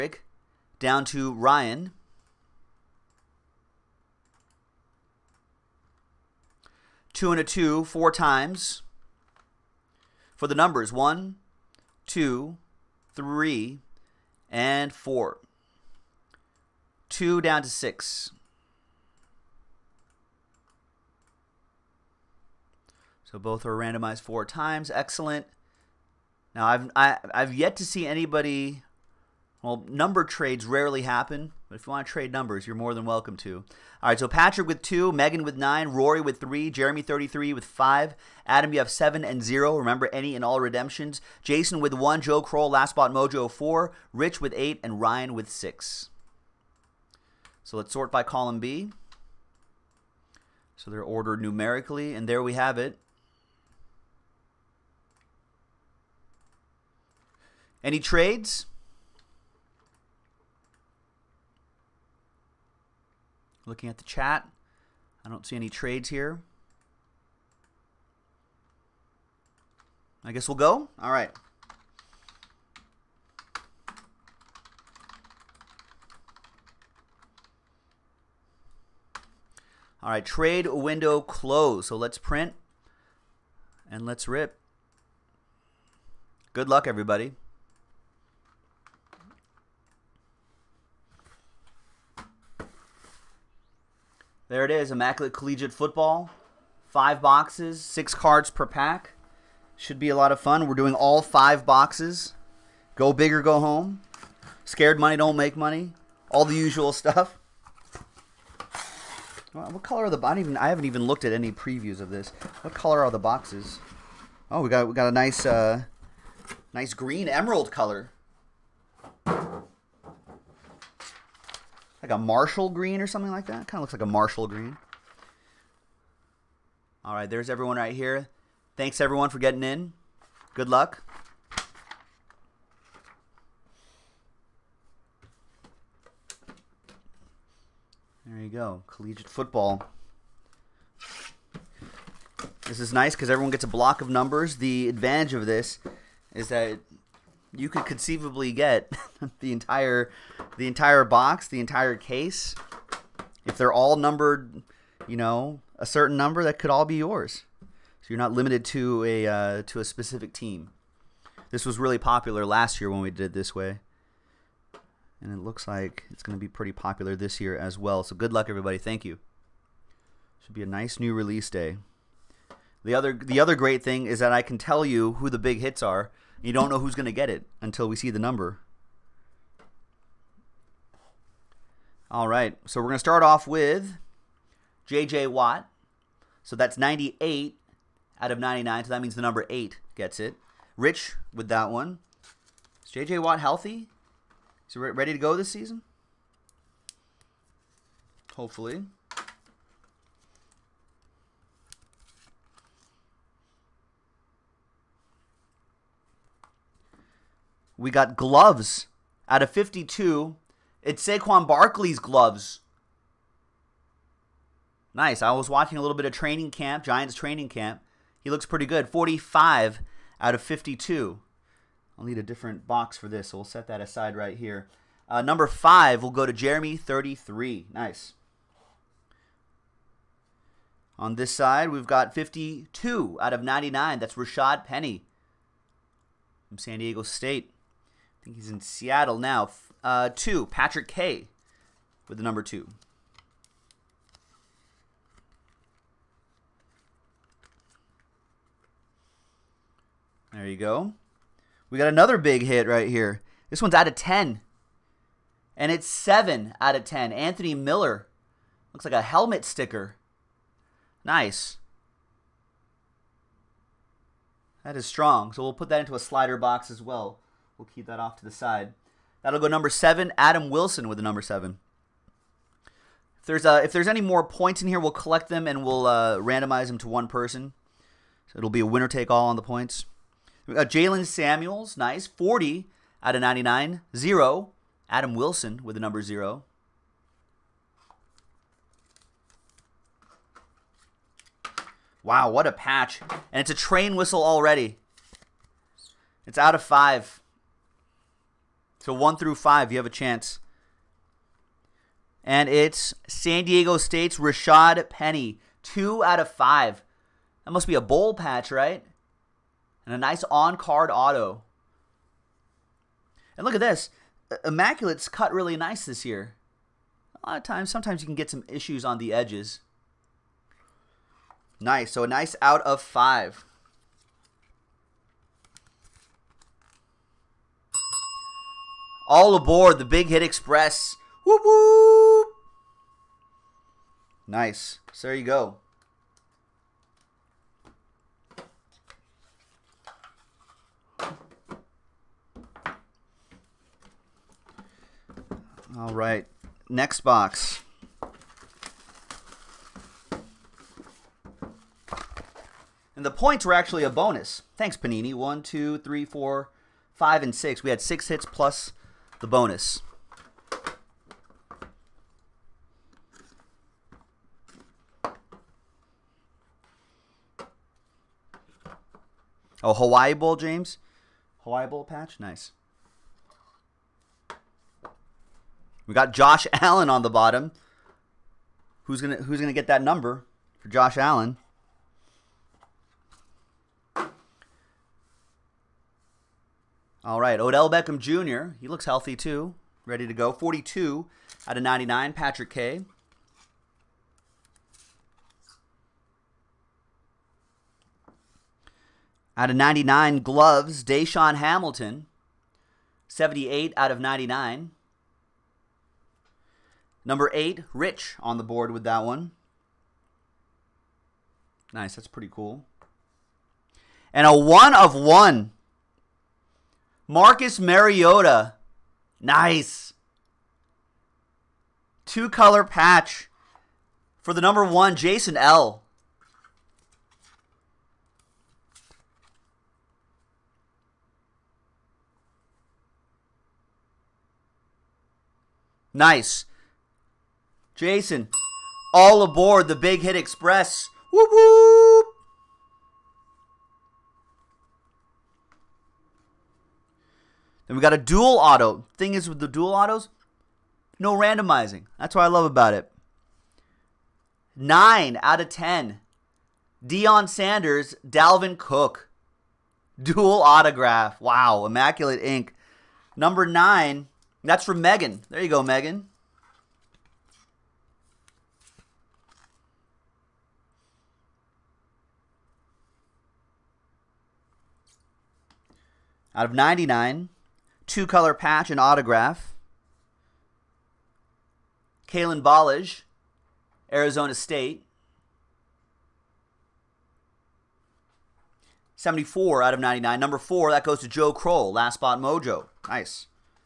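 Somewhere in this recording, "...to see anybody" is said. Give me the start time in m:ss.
0:27.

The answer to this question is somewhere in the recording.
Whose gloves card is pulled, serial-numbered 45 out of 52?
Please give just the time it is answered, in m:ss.
3:31.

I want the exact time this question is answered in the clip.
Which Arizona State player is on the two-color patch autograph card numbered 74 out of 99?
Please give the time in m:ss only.
8:02.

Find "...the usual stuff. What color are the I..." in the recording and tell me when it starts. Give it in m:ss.
1:46.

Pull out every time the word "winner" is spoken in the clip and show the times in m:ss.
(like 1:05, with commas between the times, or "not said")
4:38.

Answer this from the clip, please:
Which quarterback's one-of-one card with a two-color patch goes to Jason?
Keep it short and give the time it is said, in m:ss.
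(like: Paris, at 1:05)
Marcus Mariota, at 6:57.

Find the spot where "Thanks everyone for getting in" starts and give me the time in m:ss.
2:08.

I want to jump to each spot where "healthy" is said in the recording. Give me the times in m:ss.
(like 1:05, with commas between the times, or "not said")
3:13, 6:28.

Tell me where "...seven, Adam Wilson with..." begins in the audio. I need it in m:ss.
4:29.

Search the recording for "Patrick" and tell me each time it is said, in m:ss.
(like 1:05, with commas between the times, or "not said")
0:34, 4:00, 6:32.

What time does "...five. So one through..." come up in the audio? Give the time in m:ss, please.
4:56.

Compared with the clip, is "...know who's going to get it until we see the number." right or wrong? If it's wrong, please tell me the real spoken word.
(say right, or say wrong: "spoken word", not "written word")
right.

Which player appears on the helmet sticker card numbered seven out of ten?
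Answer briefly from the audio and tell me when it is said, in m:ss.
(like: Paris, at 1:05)
Anthony Miller, at 4:17.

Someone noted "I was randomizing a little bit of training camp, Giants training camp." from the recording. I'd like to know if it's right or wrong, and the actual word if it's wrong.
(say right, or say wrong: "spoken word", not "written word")
wrong: "watching", not "randomizing".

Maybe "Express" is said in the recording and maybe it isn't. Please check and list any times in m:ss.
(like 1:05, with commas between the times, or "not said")
5:30, 7:20.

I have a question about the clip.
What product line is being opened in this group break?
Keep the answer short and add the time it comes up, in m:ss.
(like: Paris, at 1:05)
Immaculate Collegiate Football, at 1:34.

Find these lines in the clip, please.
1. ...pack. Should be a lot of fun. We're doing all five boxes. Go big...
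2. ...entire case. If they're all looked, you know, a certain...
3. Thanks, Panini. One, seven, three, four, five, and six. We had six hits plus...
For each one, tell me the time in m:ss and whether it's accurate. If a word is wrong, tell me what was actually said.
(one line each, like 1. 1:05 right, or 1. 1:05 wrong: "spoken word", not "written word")
1. 1:38 right
2. 2:31 wrong: "numbered", not "looked"
3. 5:54 wrong: "two", not "seven".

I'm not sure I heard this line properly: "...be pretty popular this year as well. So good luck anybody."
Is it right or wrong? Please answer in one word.
wrong.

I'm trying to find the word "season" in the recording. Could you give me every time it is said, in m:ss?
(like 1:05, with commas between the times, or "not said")
3:15.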